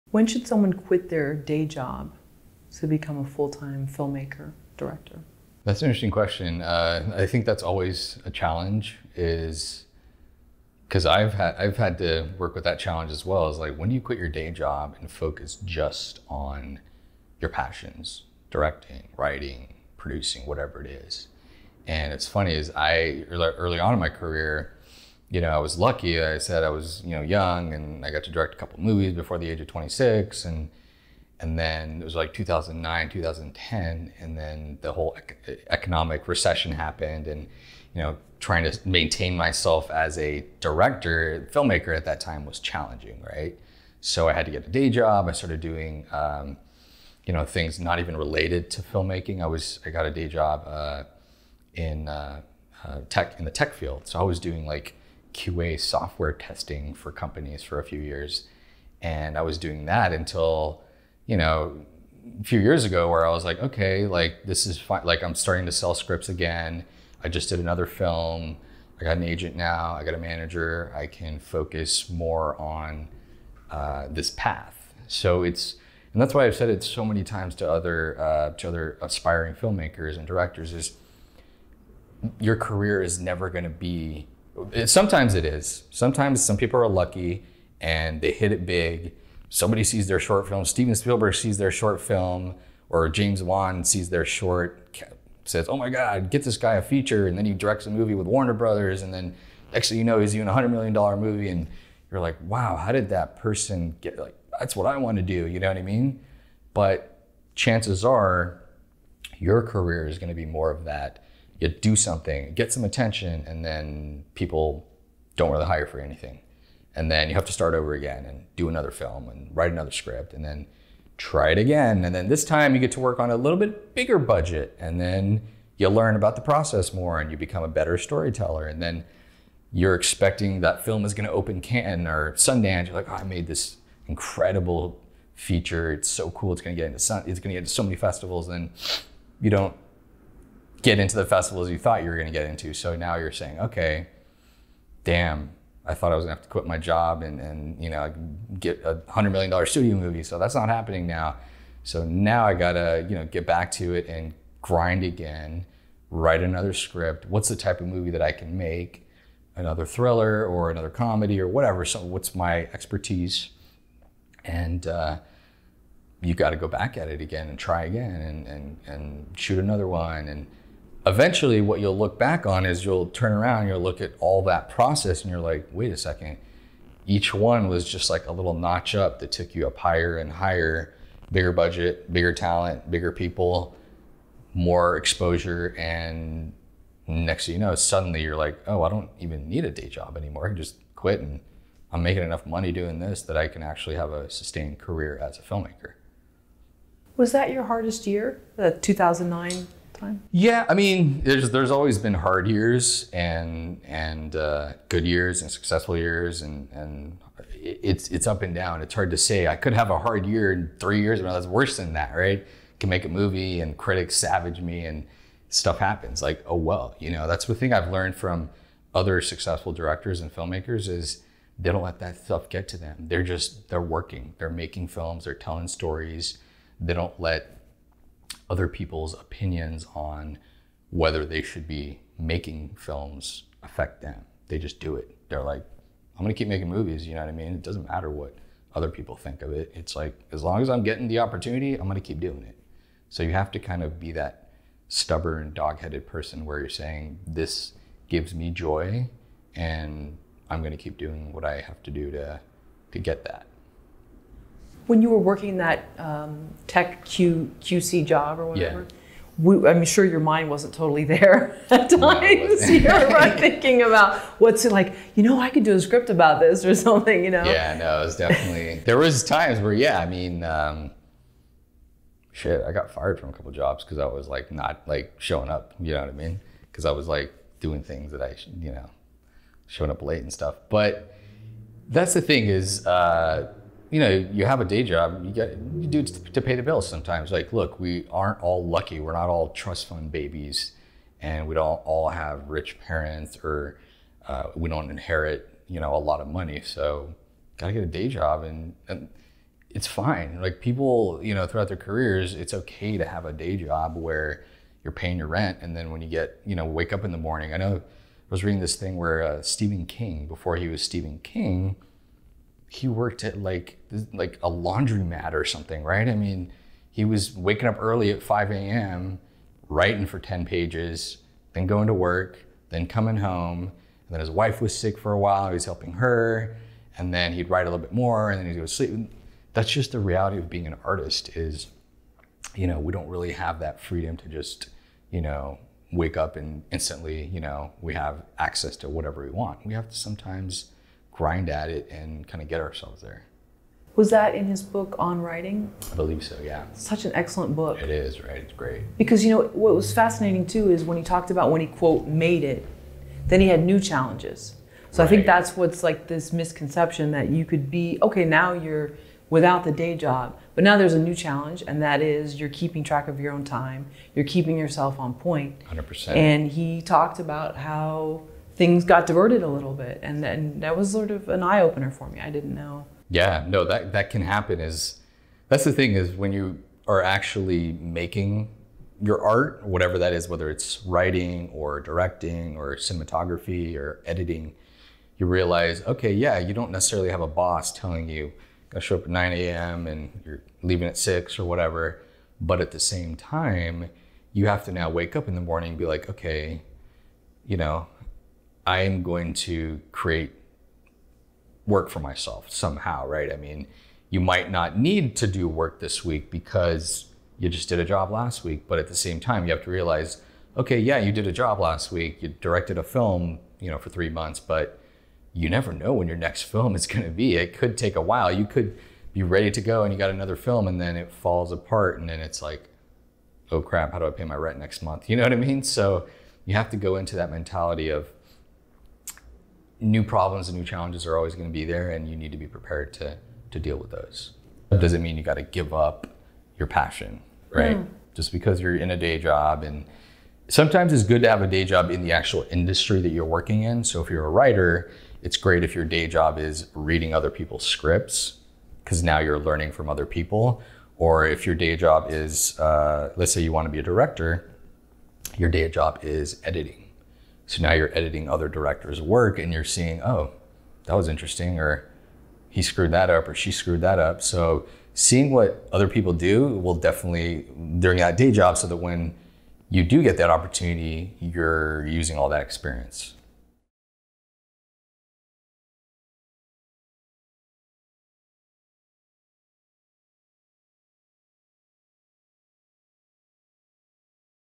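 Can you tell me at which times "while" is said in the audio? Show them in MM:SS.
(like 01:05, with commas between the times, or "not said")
05:25, 06:58.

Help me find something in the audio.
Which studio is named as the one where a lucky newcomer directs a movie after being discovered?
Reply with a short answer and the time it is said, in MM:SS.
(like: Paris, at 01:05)
Warner Brothers, at 01:38.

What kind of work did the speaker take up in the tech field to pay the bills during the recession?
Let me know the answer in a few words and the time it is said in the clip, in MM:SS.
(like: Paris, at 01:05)
QA software testing, at 00:55.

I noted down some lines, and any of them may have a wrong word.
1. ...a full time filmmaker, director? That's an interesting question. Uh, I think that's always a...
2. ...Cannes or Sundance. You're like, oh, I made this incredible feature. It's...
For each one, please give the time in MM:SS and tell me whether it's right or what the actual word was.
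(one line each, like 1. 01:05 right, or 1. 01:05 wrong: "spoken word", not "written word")
1. 00:03 right
2. 02:11 right.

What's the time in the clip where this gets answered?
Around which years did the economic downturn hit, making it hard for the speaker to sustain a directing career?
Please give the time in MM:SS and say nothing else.
00:32.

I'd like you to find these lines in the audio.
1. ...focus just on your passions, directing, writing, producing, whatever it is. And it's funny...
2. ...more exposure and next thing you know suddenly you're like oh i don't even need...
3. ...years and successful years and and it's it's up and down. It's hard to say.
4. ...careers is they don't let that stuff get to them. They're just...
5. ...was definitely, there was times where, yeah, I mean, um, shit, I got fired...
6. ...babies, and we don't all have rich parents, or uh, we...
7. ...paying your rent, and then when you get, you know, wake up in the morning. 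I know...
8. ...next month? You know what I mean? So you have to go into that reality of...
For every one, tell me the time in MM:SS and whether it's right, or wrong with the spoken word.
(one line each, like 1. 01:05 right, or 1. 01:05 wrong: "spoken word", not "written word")
1. 00:15 right
2. 03:04 right
3. 03:25 right
4. 03:40 wrong: "filmmakers", not "careers"
5. 04:28 right
6. 04:50 right
7. 05:04 right
8. 07:04 wrong: "mentality", not "reality".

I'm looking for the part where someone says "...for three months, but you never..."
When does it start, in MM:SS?
06:53.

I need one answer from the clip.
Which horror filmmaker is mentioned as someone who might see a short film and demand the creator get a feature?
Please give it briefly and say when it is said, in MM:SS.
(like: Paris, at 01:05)
James Wan, at 01:33.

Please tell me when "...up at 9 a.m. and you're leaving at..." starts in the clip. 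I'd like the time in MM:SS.
06:28.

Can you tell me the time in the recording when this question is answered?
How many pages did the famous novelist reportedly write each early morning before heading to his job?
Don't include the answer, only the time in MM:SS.
05:20.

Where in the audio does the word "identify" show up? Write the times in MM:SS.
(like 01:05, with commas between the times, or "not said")
not said.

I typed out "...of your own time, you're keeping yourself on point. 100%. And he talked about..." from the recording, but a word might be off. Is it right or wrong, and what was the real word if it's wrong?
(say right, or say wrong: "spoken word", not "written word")
right.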